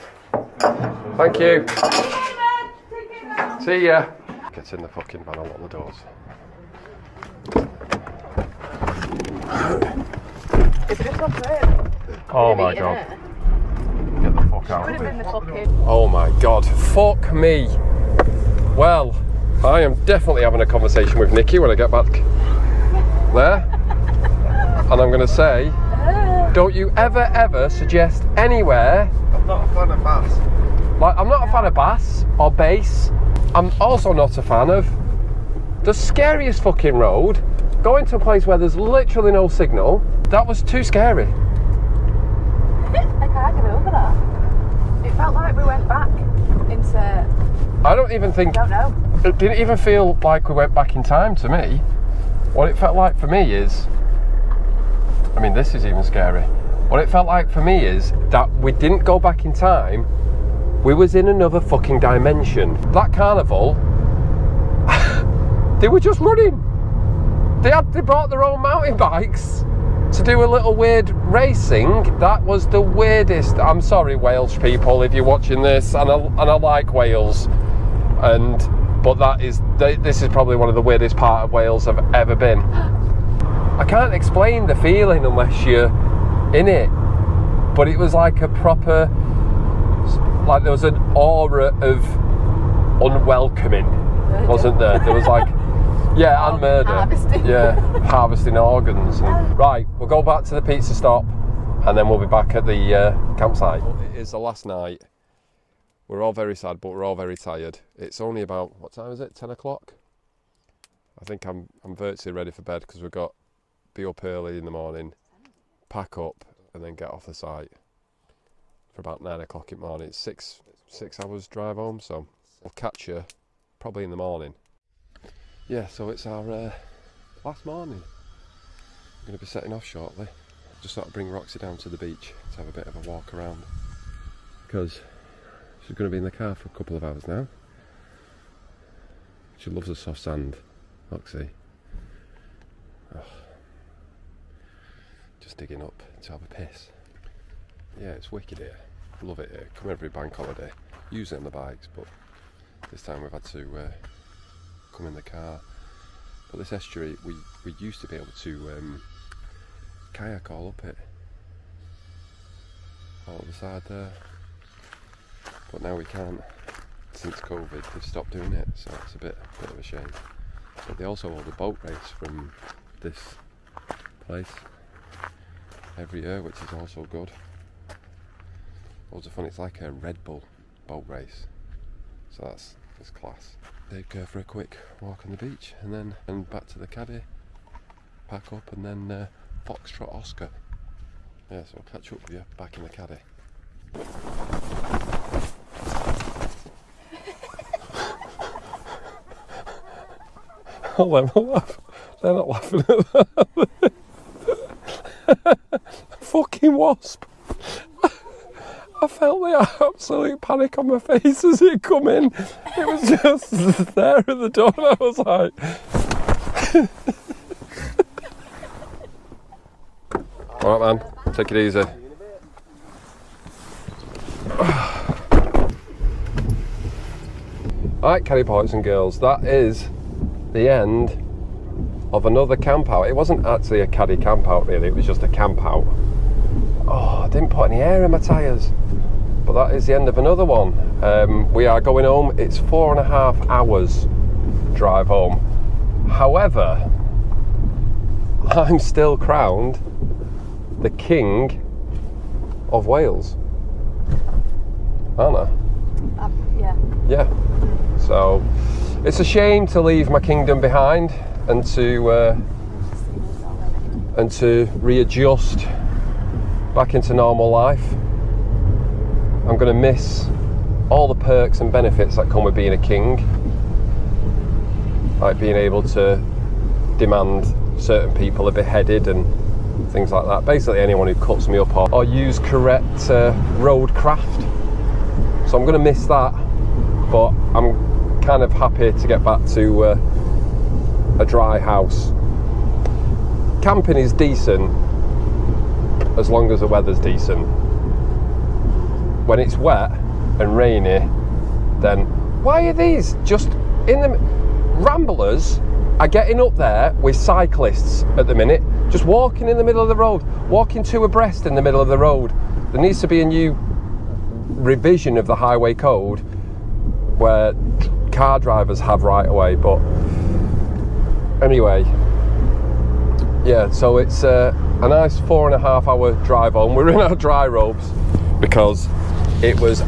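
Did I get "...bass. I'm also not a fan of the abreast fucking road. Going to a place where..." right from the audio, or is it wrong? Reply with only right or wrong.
wrong.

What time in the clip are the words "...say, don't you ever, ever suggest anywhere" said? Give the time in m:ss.
0:25.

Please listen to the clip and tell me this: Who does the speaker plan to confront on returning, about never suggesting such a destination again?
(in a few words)
Nikki.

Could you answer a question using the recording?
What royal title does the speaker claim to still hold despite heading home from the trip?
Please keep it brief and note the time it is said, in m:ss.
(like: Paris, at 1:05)
King of Wales, at 4:10.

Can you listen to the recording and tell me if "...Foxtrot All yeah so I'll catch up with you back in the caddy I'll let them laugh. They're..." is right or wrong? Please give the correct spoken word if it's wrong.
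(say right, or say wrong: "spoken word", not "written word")
wrong: "Oscar", not "All".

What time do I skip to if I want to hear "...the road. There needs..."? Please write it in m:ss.
5:11.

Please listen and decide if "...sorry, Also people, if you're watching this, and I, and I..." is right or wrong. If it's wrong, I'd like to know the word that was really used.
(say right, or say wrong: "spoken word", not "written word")
wrong: "Welsh", not "Also".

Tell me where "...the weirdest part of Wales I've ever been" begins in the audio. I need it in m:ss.
1:20.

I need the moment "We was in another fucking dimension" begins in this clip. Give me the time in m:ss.
1:00.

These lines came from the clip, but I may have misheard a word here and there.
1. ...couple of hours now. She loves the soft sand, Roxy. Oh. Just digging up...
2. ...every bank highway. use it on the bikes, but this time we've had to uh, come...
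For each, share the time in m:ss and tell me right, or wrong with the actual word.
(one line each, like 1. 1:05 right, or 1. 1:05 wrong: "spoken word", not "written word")
1. 2:16 right
2. 2:29 wrong: "holiday", not "highway".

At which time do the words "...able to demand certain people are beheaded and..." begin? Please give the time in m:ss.
4:35.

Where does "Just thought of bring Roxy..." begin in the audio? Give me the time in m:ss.
2:10.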